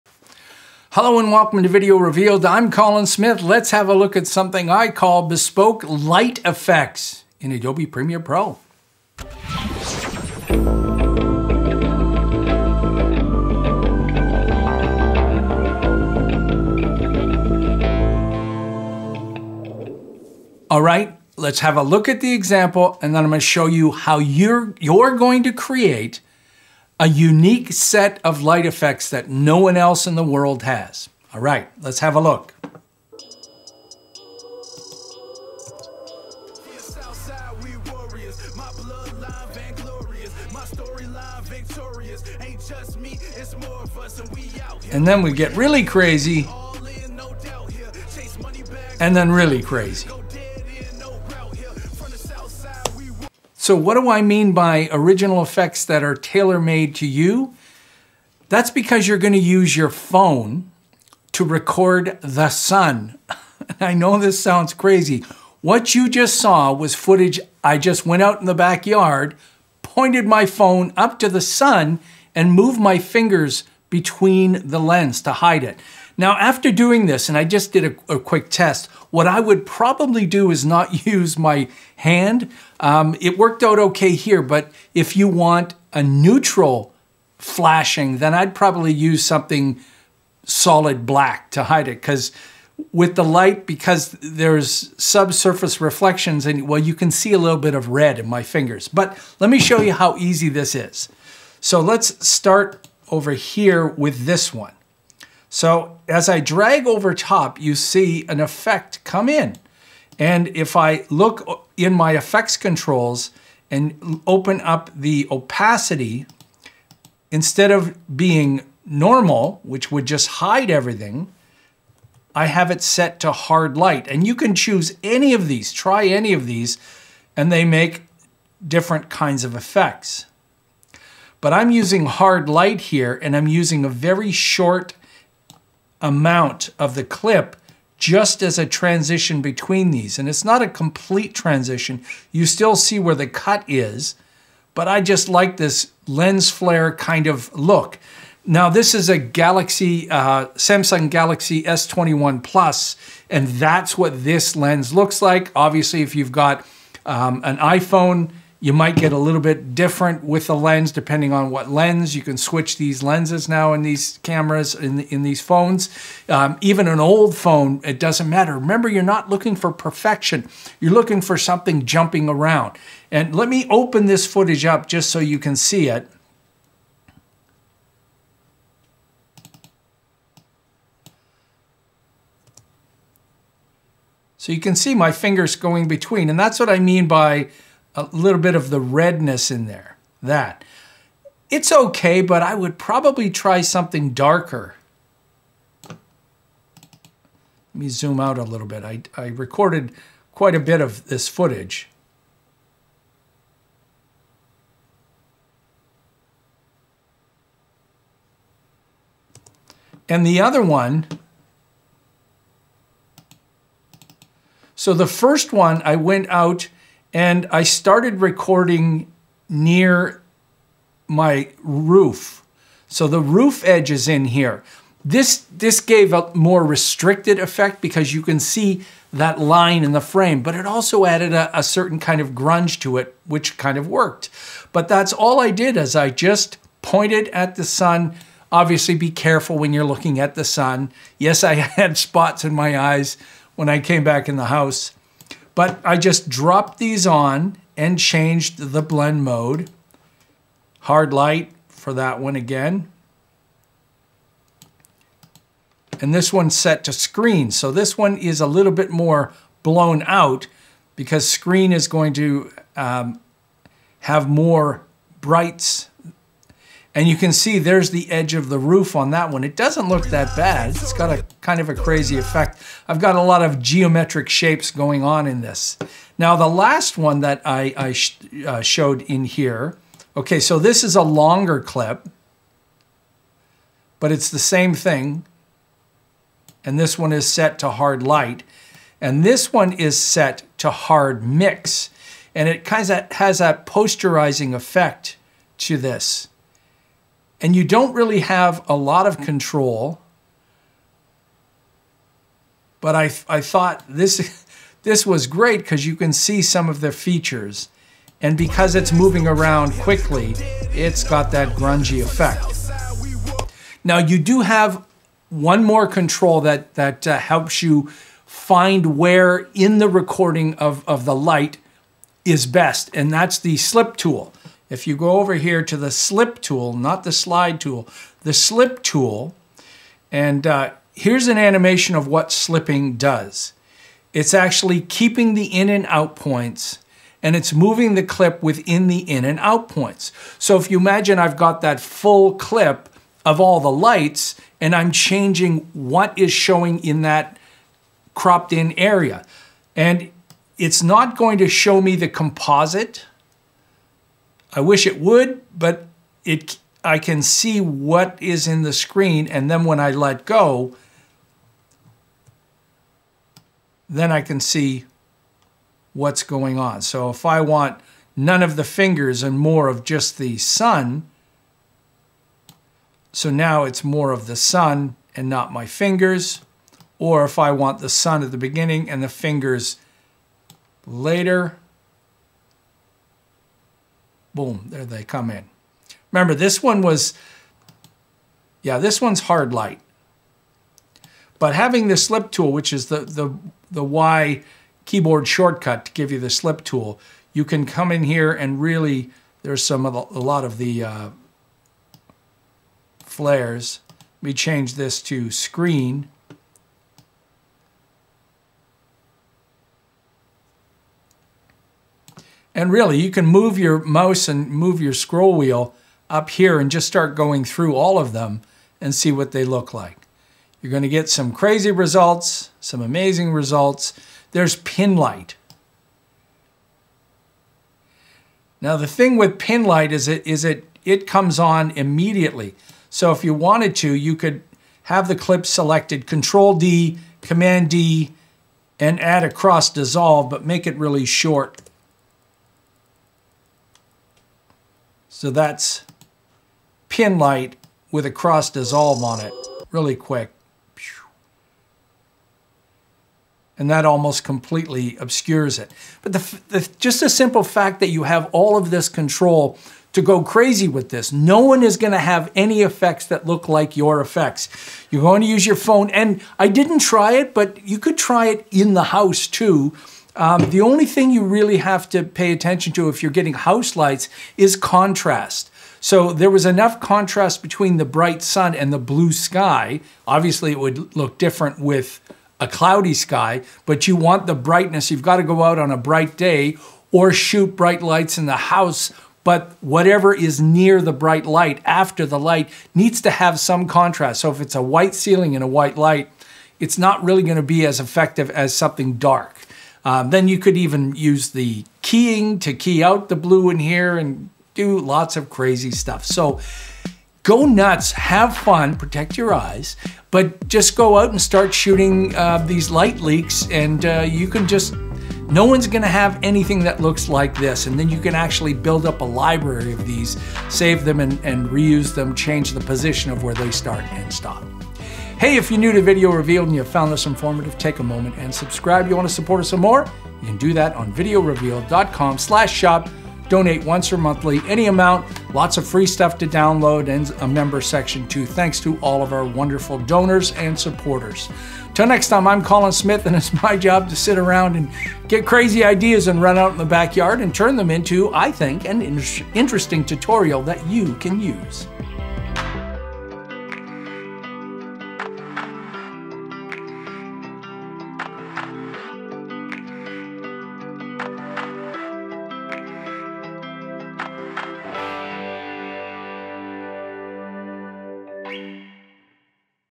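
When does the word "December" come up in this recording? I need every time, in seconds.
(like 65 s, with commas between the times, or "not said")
not said.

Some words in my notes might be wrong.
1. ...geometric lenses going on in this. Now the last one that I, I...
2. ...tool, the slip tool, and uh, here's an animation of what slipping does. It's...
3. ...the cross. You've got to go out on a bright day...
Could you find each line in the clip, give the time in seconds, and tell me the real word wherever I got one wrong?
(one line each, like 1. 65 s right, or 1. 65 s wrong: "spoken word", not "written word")
1. 273 s wrong: "shapes", not "lenses"
2. 327 s right
3. 484 s wrong: "brightness", not "cross".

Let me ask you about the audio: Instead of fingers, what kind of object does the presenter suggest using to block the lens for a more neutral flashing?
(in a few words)
something solid black.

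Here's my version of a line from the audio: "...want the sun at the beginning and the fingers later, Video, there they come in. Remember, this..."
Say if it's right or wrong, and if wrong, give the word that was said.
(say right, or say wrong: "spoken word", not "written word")
wrong: "Boom", not "Video".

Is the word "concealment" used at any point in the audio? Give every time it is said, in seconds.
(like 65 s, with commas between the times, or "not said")
not said.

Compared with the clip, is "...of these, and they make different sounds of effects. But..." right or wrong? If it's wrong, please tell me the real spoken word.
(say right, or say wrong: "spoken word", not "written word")
wrong: "kinds", not "sounds".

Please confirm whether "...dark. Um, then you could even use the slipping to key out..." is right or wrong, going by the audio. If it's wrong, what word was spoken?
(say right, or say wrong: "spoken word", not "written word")
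wrong: "keying", not "slipping".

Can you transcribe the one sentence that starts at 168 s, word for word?
Remember, you're not looking for perfection.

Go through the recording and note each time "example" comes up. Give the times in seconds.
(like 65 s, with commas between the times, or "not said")
22 s.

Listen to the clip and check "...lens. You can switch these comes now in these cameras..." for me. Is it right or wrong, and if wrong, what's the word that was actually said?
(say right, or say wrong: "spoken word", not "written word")
wrong: "lenses", not "comes".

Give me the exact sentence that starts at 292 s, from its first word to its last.
And it kind of has that posterizing effect to this and you don't really have a lot of control.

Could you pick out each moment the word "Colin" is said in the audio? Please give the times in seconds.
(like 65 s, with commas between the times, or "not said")
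2 s, 542 s.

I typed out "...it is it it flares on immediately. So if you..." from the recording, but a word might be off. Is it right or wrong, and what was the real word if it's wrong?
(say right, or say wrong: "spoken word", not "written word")
wrong: "comes", not "flares".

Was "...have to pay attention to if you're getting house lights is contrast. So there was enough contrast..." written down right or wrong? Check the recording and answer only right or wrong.
right.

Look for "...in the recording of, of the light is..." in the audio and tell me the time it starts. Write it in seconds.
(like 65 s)
319 s.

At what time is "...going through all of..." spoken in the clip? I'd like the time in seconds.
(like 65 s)
417 s.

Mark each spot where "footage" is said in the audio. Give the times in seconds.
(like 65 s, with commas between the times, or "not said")
66 s, 174 s, 201 s.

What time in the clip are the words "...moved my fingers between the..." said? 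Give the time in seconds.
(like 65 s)
72 s.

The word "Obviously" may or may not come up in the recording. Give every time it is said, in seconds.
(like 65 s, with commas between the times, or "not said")
155 s, 238 s, 480 s.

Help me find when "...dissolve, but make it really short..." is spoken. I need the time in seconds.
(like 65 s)
439 s.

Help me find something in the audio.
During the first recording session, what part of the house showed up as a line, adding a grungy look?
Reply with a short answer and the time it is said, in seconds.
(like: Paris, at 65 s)
roof edge, at 223 s.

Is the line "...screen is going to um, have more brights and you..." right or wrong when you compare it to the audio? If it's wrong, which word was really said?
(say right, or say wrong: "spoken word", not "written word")
right.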